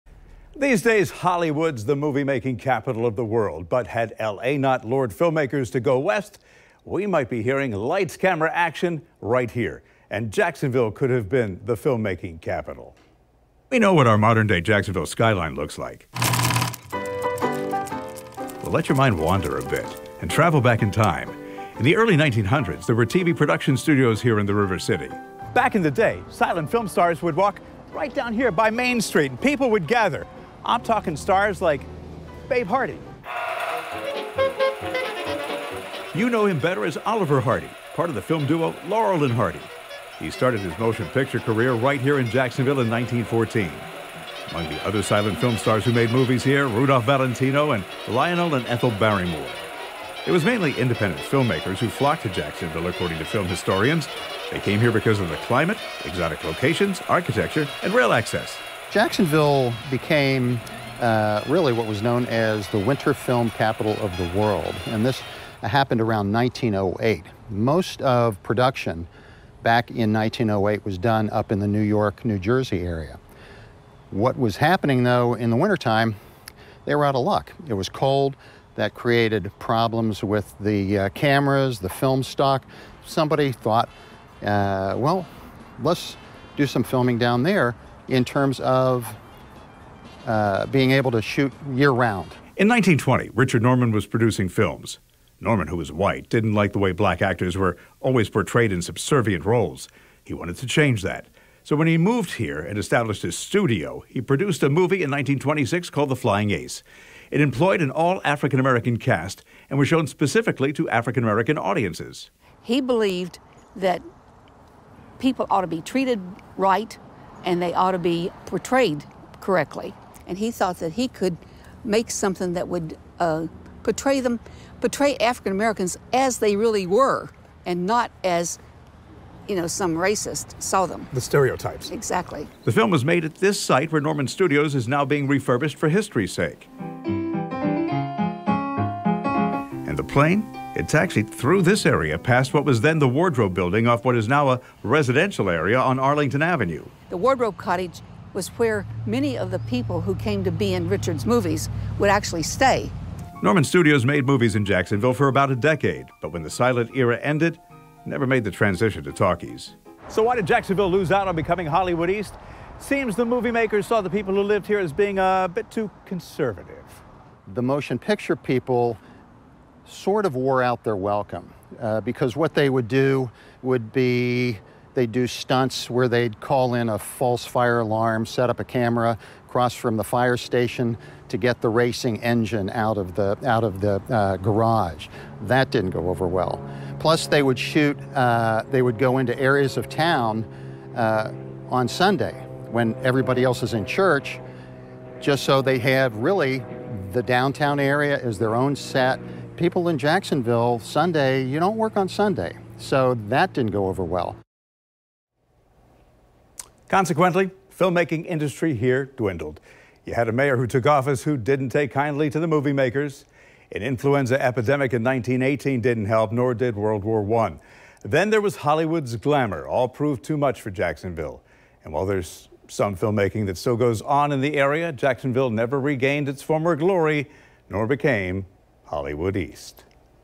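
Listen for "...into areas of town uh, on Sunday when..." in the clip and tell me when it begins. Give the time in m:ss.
3:09.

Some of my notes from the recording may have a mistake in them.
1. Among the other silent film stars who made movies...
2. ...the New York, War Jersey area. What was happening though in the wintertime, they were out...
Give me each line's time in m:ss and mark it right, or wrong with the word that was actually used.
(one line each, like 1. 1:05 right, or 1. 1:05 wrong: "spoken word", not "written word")
1. 0:44 right
2. 1:11 wrong: "New", not "War".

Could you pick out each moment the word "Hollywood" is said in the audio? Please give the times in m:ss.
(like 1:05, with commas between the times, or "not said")
0:01, 2:41, 3:38, 3:48.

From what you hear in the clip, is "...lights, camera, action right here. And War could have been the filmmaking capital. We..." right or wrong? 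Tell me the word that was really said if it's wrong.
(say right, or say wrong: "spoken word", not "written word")
wrong: "Jacksonville", not "War".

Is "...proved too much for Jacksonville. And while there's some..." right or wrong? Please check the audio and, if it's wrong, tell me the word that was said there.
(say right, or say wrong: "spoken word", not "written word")
right.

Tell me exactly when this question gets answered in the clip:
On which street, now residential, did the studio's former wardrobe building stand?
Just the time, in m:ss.
2:25.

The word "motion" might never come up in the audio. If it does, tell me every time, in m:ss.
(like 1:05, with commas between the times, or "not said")
0:40, 2:47.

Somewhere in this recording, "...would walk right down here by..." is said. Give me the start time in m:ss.
0:27.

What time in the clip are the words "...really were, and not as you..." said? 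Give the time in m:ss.
2:06.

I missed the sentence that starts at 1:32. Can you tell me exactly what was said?
In 1920, Richard Norman was producing films.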